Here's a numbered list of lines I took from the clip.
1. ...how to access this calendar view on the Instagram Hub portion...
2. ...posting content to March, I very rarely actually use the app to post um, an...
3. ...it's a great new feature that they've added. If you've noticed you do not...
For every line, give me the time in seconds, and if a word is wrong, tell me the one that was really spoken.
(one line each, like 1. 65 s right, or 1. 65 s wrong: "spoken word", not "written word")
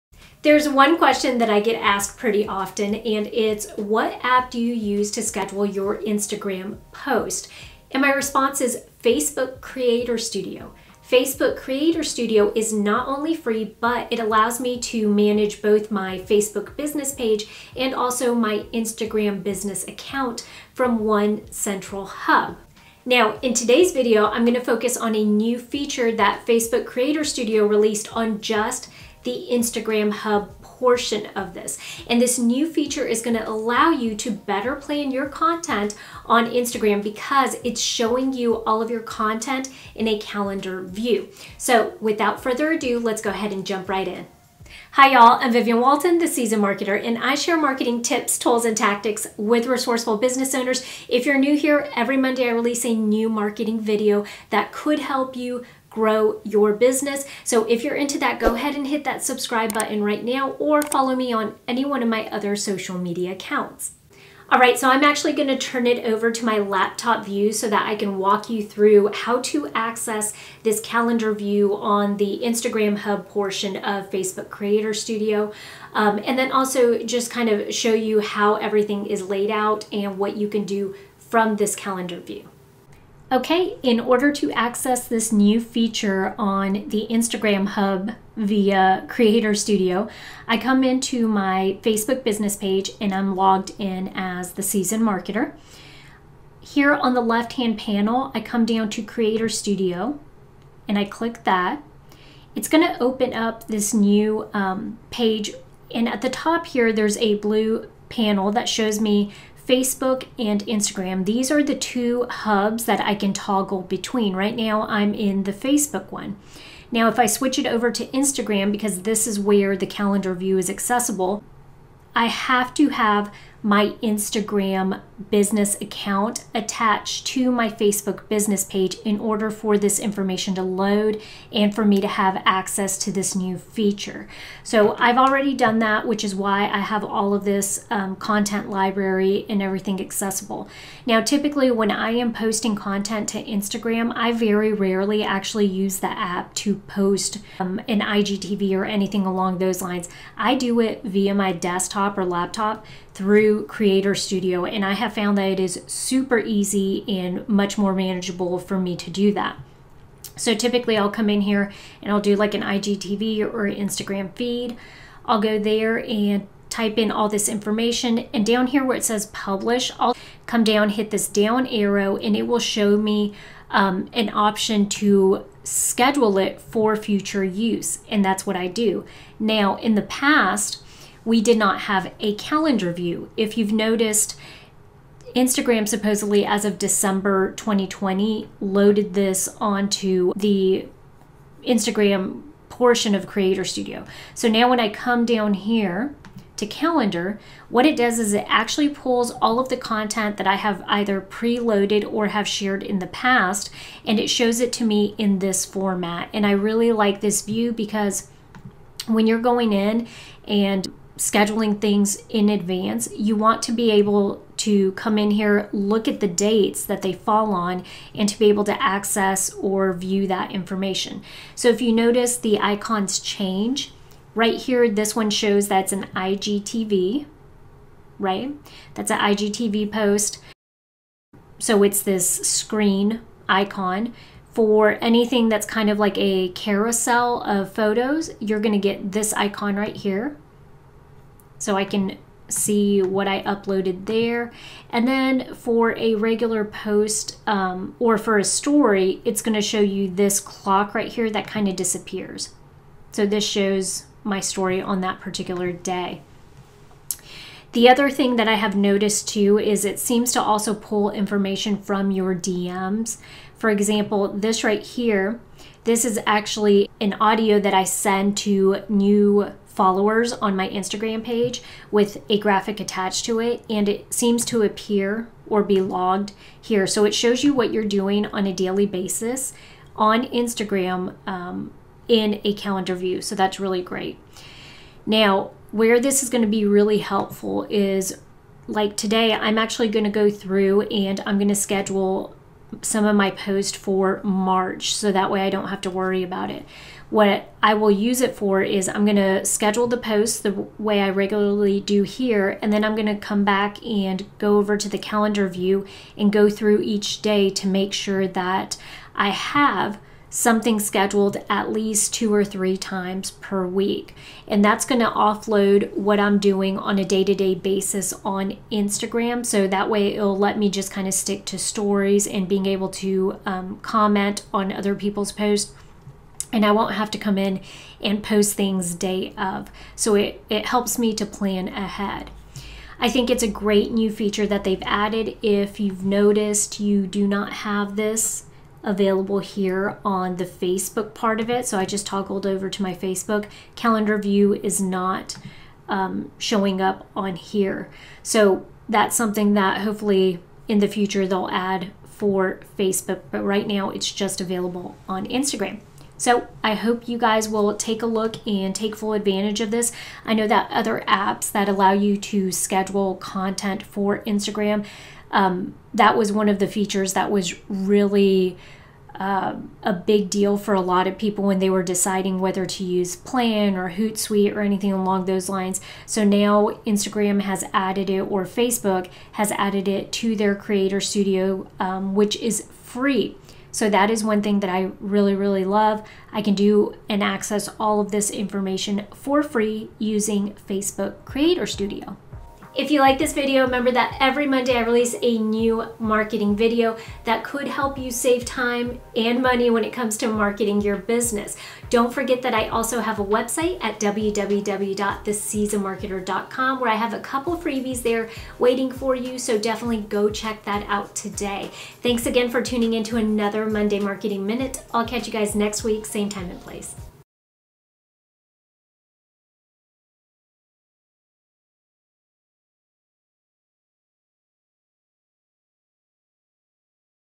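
1. 69 s right
2. 142 s wrong: "Instagram", not "March"
3. 333 s right.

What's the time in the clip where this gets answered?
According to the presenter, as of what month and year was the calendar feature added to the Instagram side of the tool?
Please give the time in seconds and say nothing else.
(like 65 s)
186 s.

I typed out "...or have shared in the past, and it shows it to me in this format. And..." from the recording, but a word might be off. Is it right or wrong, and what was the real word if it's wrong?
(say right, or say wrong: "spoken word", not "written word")
right.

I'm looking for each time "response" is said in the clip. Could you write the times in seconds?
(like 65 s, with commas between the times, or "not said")
8 s.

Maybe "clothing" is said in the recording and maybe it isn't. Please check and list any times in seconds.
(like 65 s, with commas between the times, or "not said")
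not said.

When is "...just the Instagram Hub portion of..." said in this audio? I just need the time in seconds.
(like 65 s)
28 s.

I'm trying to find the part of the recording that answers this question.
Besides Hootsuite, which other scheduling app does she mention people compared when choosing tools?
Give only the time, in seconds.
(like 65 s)
373 s.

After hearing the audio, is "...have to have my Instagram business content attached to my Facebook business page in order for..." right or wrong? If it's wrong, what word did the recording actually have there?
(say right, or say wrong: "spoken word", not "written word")
wrong: "account", not "content".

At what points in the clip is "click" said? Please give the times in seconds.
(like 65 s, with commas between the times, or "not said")
101 s.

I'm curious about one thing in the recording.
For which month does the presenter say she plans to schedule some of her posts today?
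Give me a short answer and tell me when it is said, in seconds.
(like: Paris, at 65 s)
March, at 294 s.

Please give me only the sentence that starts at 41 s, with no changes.
So without further ado, let's go ahead and jump right in.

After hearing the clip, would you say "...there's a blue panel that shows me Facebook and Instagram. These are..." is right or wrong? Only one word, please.
right.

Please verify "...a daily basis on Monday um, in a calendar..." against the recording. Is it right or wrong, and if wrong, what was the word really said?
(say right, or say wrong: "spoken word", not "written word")
wrong: "Instagram", not "Monday".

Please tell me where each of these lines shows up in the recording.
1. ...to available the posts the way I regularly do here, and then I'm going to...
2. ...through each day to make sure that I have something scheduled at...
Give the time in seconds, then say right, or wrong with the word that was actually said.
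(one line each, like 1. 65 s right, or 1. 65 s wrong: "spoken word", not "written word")
1. 299 s wrong: "schedule", not "available"
2. 306 s right.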